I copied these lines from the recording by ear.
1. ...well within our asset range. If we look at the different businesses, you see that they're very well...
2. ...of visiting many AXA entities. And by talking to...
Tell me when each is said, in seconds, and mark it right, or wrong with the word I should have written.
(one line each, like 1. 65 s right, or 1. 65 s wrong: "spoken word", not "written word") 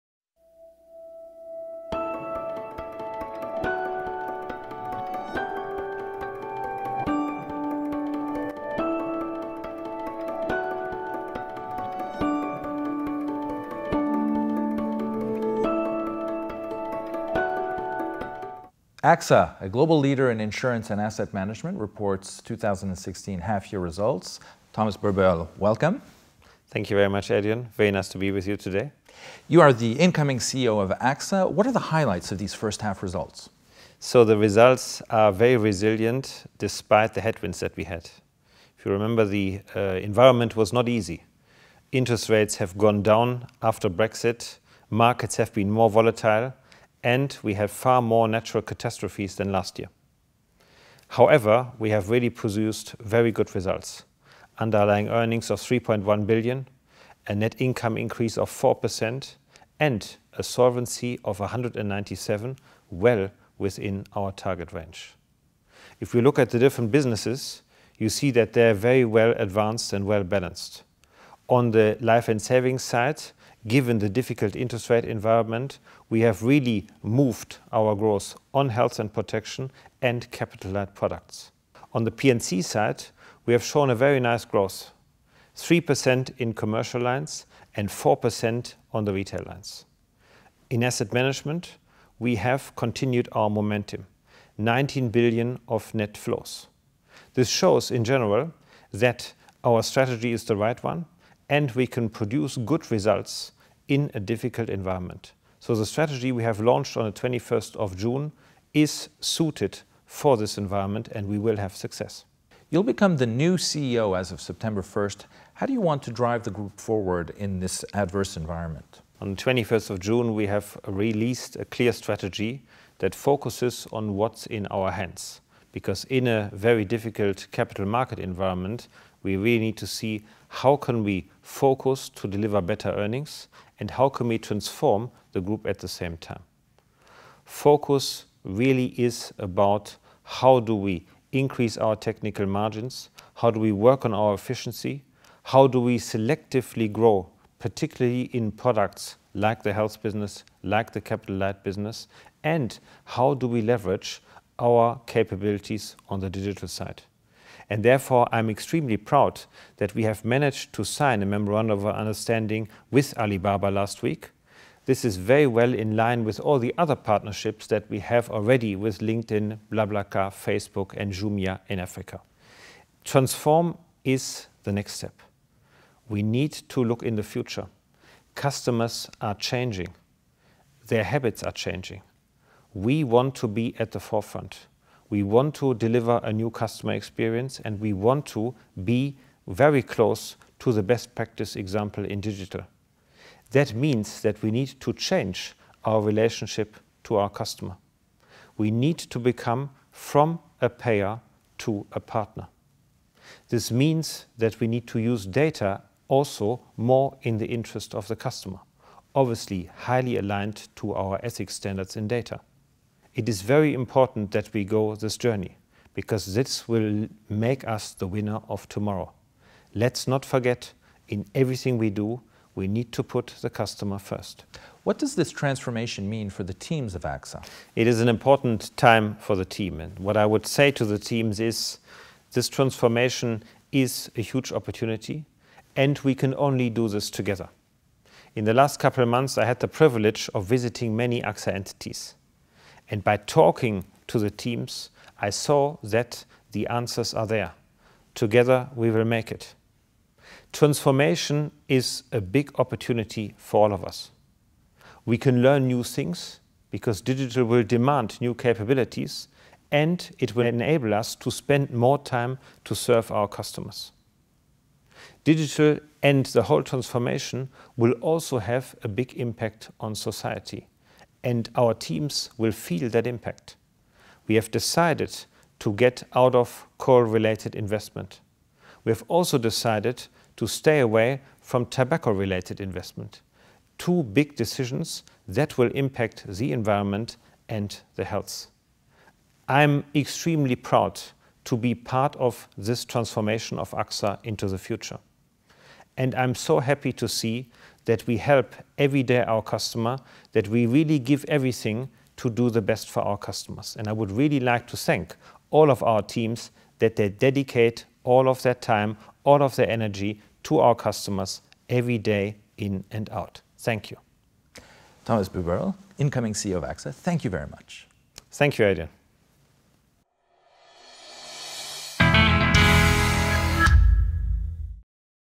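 1. 62 s wrong: "target", not "asset"
2. 240 s right.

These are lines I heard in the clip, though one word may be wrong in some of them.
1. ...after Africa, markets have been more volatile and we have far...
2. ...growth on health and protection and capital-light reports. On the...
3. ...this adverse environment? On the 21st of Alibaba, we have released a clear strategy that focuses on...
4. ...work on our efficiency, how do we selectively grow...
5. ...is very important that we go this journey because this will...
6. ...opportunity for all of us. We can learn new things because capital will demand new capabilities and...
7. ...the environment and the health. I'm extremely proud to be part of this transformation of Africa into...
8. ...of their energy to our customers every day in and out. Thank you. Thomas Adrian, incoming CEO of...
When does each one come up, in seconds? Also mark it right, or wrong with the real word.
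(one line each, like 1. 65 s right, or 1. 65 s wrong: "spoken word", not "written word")
1. 43 s wrong: "Brexit", not "Africa"
2. 77 s wrong: "products", not "reports"
3. 117 s wrong: "June", not "Alibaba"
4. 143 s right
5. 213 s right
6. 252 s wrong: "digital", not "capital"
7. 286 s wrong: "AXA", not "Africa"
8. 309 s wrong: "Buberl", not "Adrian".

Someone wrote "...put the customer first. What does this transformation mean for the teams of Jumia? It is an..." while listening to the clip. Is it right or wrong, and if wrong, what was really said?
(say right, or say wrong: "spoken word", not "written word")
wrong: "AXA", not "Jumia".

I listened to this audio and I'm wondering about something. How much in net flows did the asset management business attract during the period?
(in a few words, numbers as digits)
19 billion.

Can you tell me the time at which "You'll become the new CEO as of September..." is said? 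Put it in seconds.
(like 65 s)
112 s.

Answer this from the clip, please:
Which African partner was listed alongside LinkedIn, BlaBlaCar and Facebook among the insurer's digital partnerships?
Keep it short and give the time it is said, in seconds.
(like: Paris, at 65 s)
Jumia, at 171 s.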